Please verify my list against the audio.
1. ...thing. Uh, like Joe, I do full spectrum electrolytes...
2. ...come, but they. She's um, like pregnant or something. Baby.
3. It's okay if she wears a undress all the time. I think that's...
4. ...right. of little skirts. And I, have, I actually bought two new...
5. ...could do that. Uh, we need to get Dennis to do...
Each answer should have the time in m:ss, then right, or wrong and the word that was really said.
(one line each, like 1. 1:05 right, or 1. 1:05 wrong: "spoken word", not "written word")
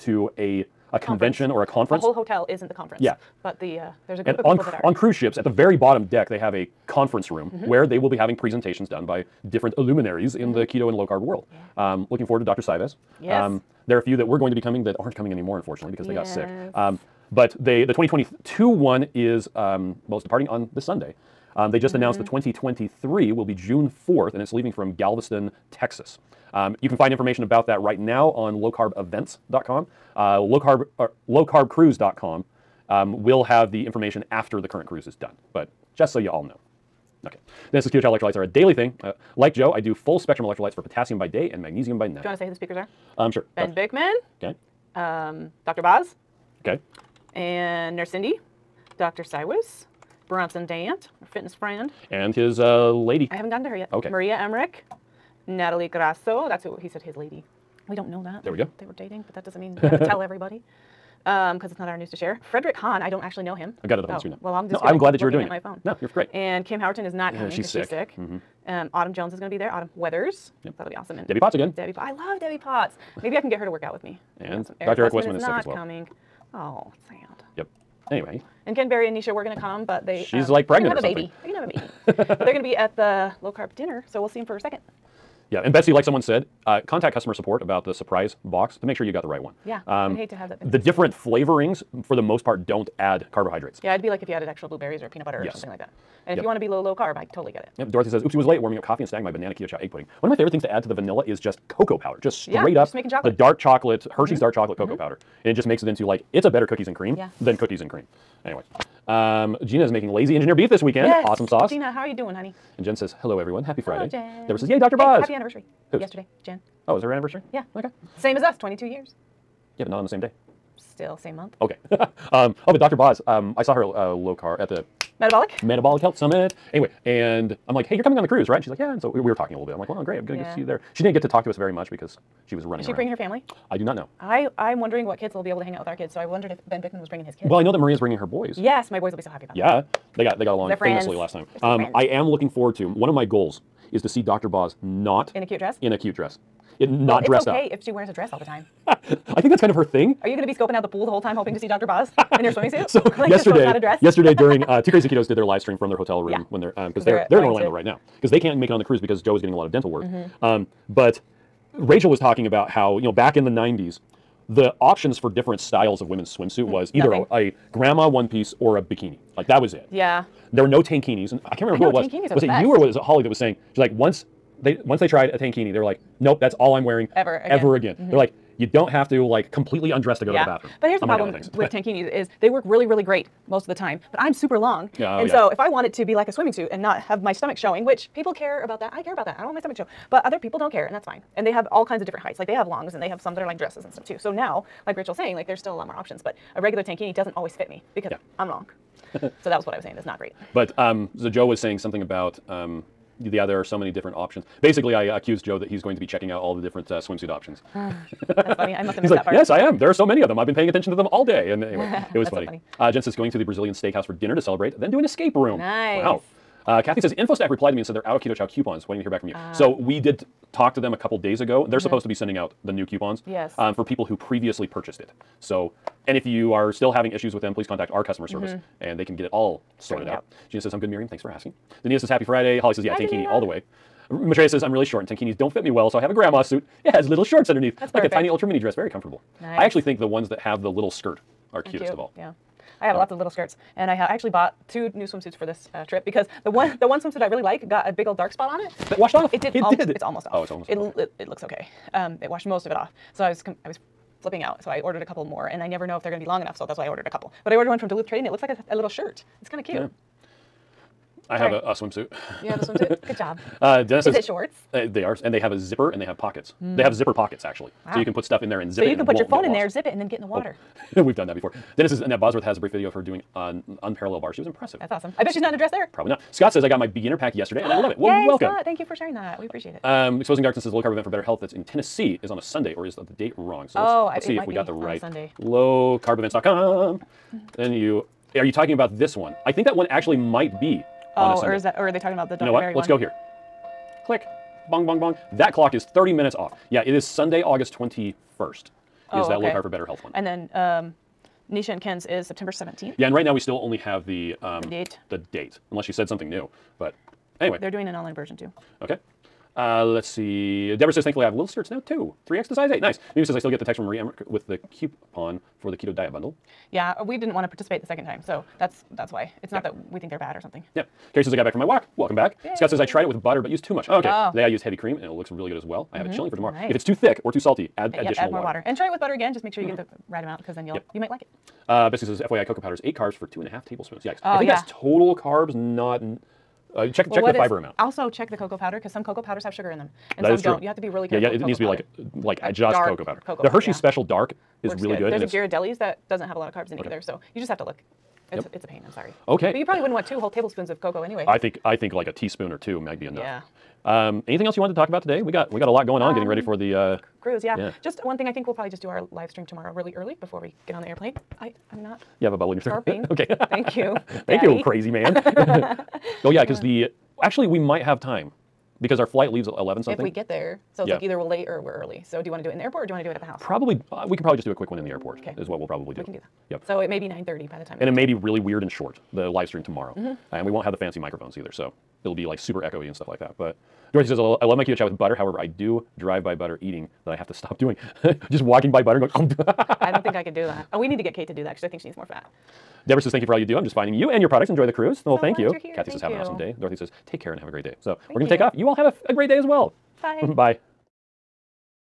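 1. 0:38 right
2. 1:19 right
3. 2:27 wrong: "dress", not "undress"
4. 4:03 right
5. 6:30 wrong: "Kate", not "Dennis".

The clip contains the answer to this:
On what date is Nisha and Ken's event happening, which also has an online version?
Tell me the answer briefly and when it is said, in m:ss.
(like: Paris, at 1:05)
September 17th, at 5:02.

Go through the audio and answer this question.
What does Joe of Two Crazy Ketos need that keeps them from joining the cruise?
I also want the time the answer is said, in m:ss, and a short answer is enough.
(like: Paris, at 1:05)
Dental work, at 2:39.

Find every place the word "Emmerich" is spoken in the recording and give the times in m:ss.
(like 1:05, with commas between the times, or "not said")
0:54, 5:13.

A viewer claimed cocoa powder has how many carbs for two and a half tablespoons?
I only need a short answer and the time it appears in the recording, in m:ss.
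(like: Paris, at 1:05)
8, at 5:32.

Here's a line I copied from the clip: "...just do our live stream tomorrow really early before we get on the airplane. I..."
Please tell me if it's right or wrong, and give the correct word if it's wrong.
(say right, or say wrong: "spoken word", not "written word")
right.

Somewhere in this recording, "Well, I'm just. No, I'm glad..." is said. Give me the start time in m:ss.
1:04.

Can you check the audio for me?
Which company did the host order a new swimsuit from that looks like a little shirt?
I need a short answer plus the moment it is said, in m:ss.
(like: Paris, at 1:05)
Duluth Trading, at 4:17.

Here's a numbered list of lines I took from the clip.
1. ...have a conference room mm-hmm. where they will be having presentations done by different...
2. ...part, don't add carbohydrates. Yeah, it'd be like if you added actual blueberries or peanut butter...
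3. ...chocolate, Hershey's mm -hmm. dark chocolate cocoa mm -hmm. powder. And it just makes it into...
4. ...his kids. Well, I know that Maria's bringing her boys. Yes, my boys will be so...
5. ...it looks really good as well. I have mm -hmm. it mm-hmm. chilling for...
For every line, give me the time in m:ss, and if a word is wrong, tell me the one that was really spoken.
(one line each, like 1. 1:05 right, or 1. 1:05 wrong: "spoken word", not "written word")
1. 0:06 right
2. 1:32 right
3. 1:43 right
4. 2:17 right
5. 5:25 right.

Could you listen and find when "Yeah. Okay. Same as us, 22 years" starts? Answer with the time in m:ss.
1:57.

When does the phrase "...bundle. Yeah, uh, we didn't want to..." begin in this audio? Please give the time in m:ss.
5:16.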